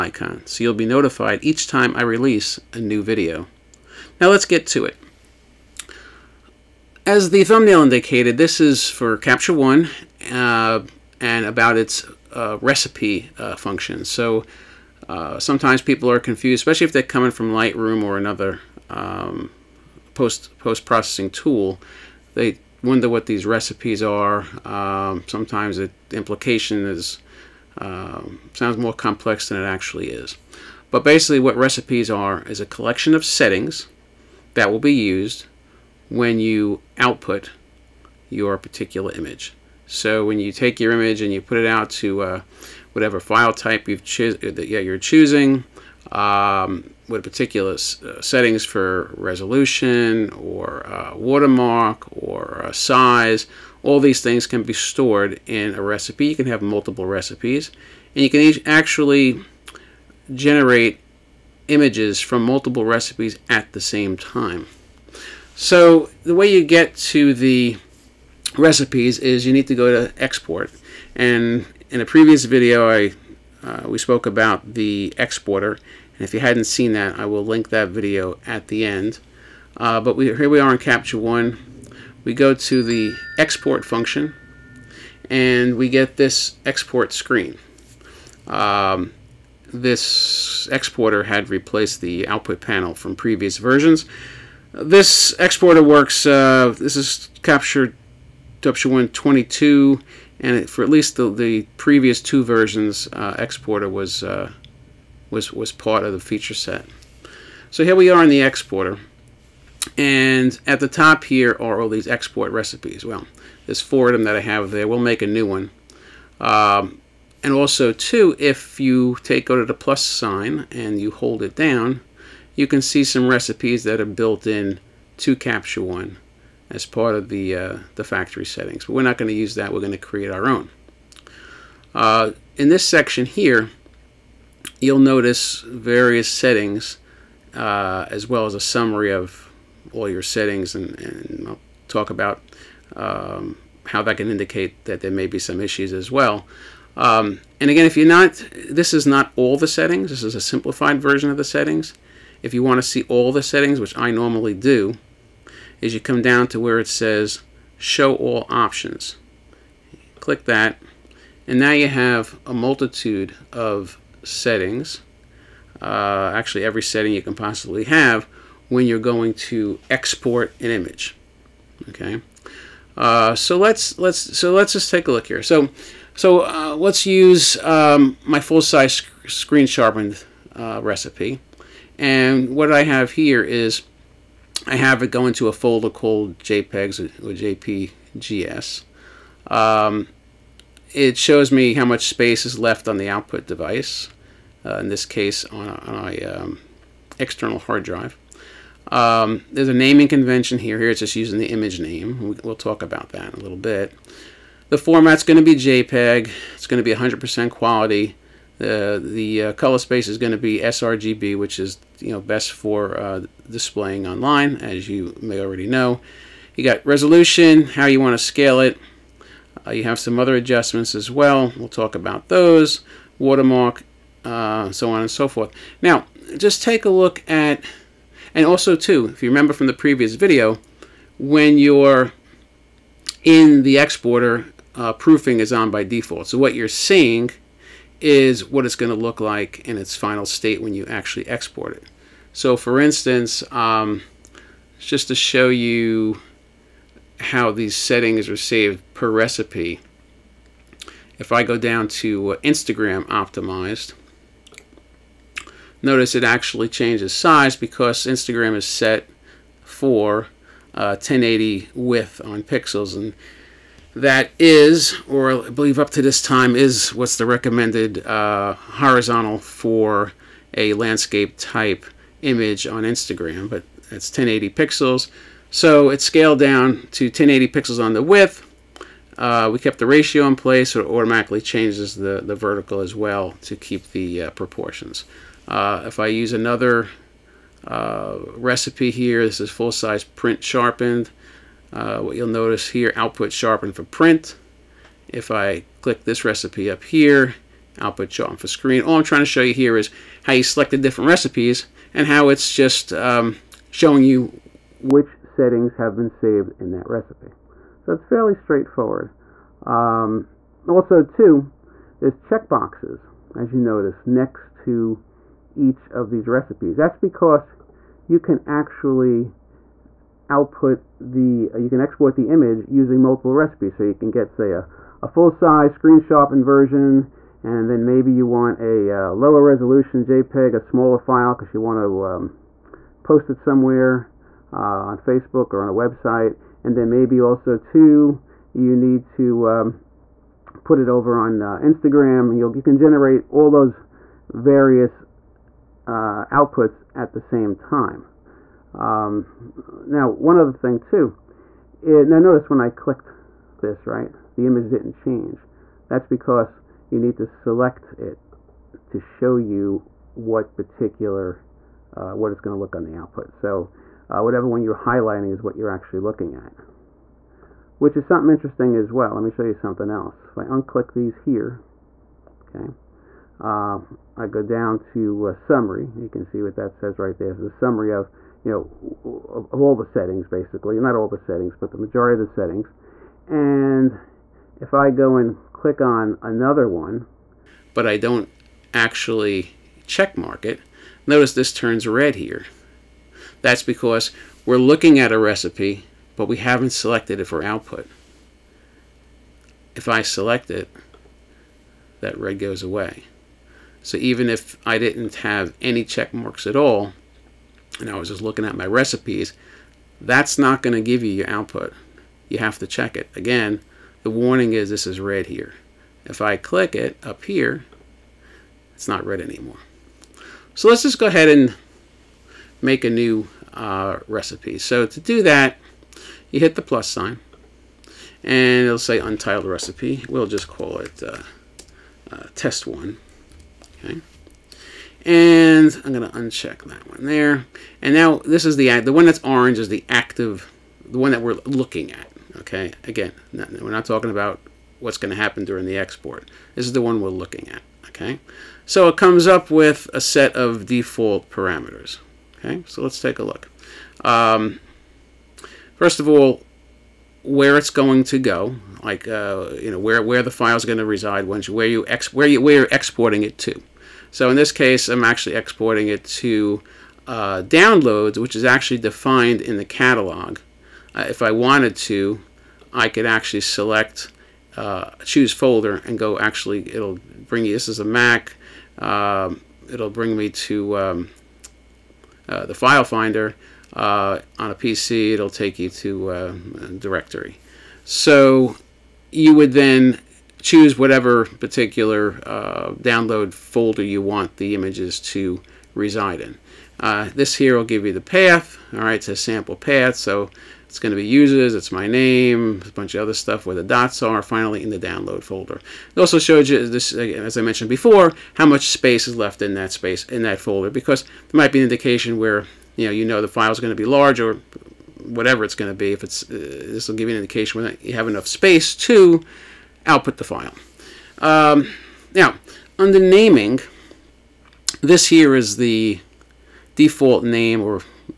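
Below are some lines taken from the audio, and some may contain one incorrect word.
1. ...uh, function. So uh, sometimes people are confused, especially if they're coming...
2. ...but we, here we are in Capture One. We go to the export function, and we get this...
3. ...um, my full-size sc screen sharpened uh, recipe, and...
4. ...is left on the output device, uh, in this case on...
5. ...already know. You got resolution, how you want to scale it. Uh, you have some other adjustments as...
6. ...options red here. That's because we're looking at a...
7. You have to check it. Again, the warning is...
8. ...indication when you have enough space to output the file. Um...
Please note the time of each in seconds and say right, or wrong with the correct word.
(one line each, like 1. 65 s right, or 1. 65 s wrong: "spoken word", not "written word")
1. 13 s right
2. 79 s right
3. 177 s right
4. 192 s right
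5. 215 s right
6. 391 s wrong: "turns", not "options"
7. 412 s right
8. 517 s right.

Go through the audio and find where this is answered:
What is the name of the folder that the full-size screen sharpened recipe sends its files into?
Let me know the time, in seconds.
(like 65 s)
186 s.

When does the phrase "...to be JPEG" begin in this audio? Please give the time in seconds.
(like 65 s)
205 s.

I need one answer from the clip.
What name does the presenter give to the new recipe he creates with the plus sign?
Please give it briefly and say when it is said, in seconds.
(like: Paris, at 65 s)
test one, at 432 s.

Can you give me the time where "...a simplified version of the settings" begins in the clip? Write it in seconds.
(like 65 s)
150 s.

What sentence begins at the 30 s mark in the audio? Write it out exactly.
But basically, what recipes are is a collection of settings that will be used when you output your particular image.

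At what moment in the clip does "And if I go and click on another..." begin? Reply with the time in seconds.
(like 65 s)
383 s.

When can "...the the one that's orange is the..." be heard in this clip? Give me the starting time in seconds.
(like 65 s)
438 s.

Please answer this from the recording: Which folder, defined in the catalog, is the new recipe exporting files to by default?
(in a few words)
Downloads.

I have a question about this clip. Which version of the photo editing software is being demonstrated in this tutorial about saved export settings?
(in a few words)
Capture One 22.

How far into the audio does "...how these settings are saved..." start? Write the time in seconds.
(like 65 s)
247 s.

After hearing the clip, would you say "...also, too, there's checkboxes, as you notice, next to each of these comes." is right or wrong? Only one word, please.
wrong.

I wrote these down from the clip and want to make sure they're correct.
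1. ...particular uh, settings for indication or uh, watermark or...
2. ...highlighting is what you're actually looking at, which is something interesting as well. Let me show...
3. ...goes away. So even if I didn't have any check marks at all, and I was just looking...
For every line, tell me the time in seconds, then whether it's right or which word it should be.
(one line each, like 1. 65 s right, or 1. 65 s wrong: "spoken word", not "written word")
1. 47 s wrong: "resolution", not "indication"
2. 364 s right
3. 402 s right.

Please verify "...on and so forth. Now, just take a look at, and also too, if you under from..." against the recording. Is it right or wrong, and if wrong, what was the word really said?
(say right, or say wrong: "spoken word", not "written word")
wrong: "remember", not "under".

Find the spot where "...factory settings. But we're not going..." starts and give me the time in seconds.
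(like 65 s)
128 s.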